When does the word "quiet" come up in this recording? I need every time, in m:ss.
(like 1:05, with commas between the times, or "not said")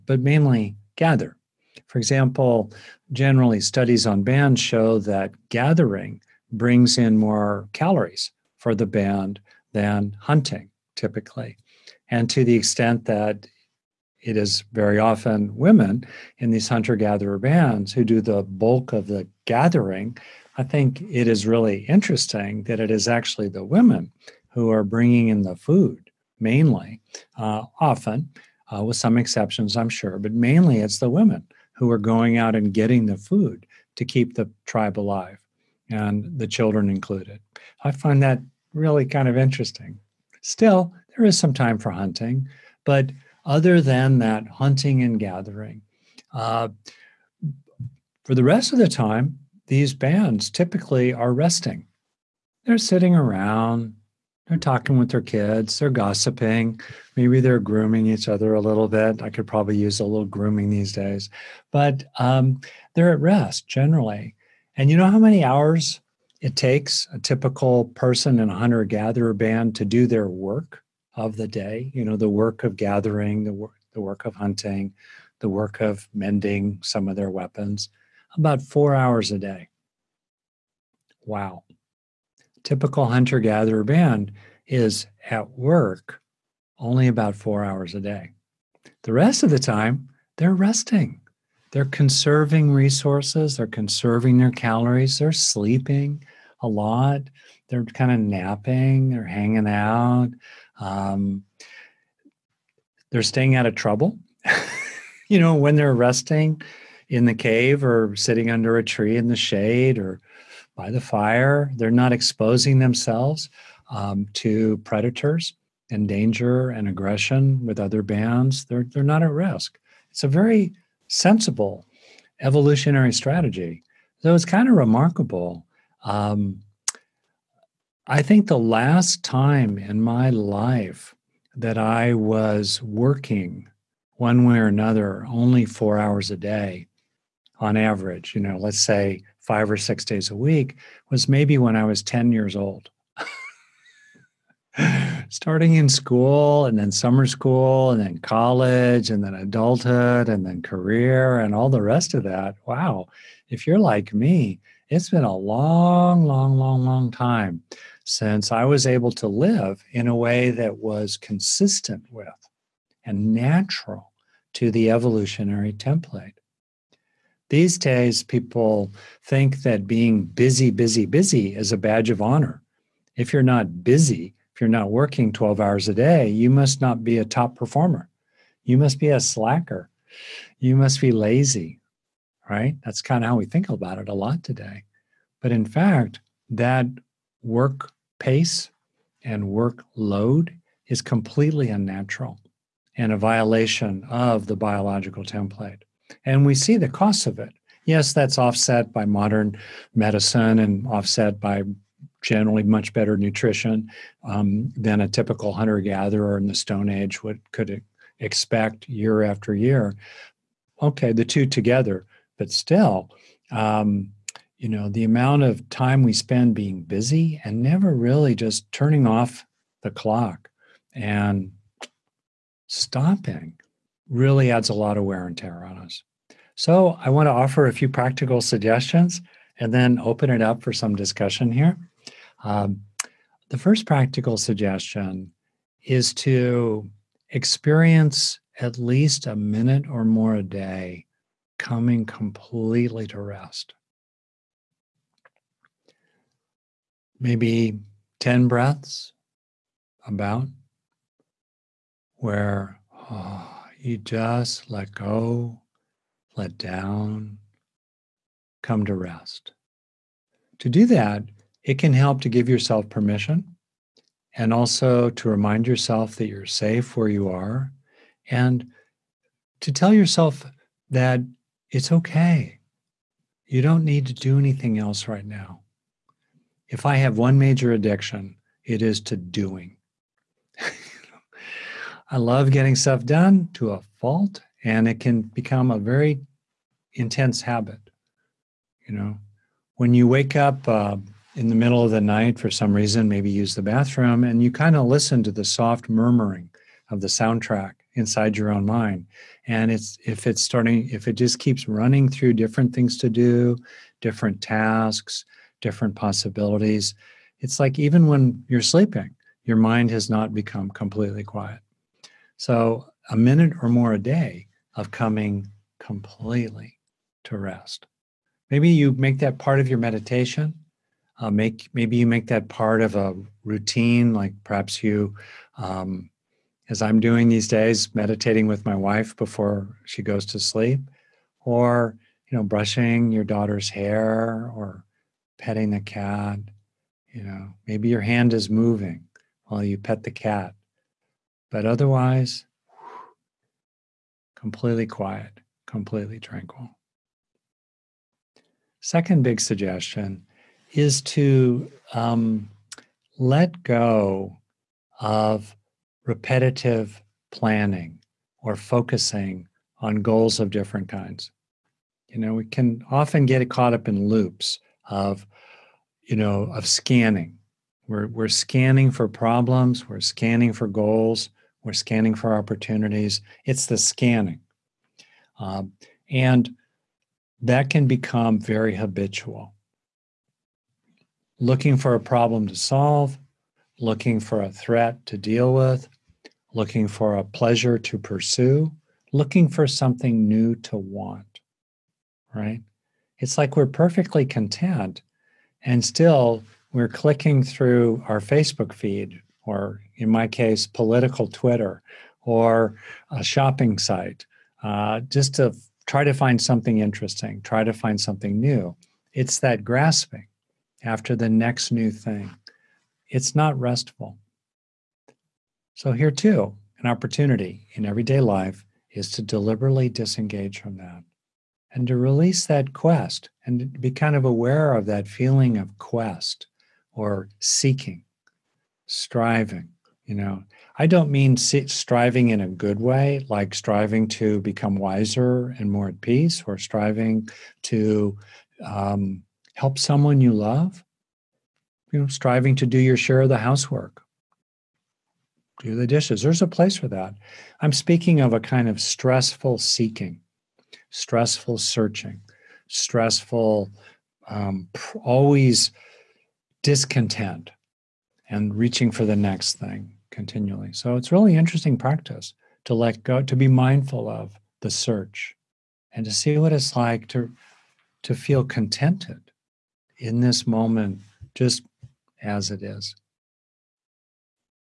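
5:11, 5:44.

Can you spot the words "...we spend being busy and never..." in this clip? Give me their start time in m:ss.
3:36.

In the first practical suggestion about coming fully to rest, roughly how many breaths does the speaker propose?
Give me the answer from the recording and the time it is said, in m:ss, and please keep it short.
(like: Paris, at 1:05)
10, at 4:08.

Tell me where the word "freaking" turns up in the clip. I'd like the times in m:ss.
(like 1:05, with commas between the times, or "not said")
not said.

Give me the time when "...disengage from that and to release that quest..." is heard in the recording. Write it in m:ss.
6:59.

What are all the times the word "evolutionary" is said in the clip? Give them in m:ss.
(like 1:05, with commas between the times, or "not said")
2:02, 2:44.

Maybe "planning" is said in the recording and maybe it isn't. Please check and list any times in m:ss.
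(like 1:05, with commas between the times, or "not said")
5:57.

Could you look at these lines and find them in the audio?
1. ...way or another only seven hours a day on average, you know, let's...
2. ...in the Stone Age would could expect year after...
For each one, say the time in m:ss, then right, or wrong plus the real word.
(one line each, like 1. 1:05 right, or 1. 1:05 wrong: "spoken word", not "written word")
1. 2:14 wrong: "four", not "seven"
2. 3:26 right.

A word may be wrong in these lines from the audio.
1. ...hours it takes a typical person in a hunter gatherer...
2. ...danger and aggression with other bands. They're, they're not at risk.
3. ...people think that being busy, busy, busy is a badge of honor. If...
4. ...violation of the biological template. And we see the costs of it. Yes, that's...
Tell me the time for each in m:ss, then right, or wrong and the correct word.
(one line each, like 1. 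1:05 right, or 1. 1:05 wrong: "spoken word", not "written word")
1. 1:05 right
2. 1:56 right
3. 2:48 right
4. 3:13 right.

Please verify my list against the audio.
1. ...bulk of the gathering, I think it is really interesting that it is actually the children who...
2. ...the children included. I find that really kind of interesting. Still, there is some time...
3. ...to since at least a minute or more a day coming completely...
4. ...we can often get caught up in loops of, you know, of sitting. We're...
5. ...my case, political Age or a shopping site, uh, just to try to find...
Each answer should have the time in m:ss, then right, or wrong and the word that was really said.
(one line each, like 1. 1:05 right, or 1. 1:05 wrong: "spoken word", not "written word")
1. 0:18 wrong: "women", not "children"
2. 0:36 right
3. 3:56 wrong: "experience", not "since"
4. 6:02 wrong: "scanning", not "sitting"
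5. 6:40 wrong: "Twitter", not "Age".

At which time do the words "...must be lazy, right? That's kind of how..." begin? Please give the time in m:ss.
3:00.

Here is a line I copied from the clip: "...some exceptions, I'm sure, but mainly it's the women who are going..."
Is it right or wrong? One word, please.
right.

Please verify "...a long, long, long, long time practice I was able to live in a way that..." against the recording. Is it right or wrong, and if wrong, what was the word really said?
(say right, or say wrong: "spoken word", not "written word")
wrong: "since", not "practice".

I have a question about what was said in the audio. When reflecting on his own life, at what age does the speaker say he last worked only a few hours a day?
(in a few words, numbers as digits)
10.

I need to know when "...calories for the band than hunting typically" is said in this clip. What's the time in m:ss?
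0:07.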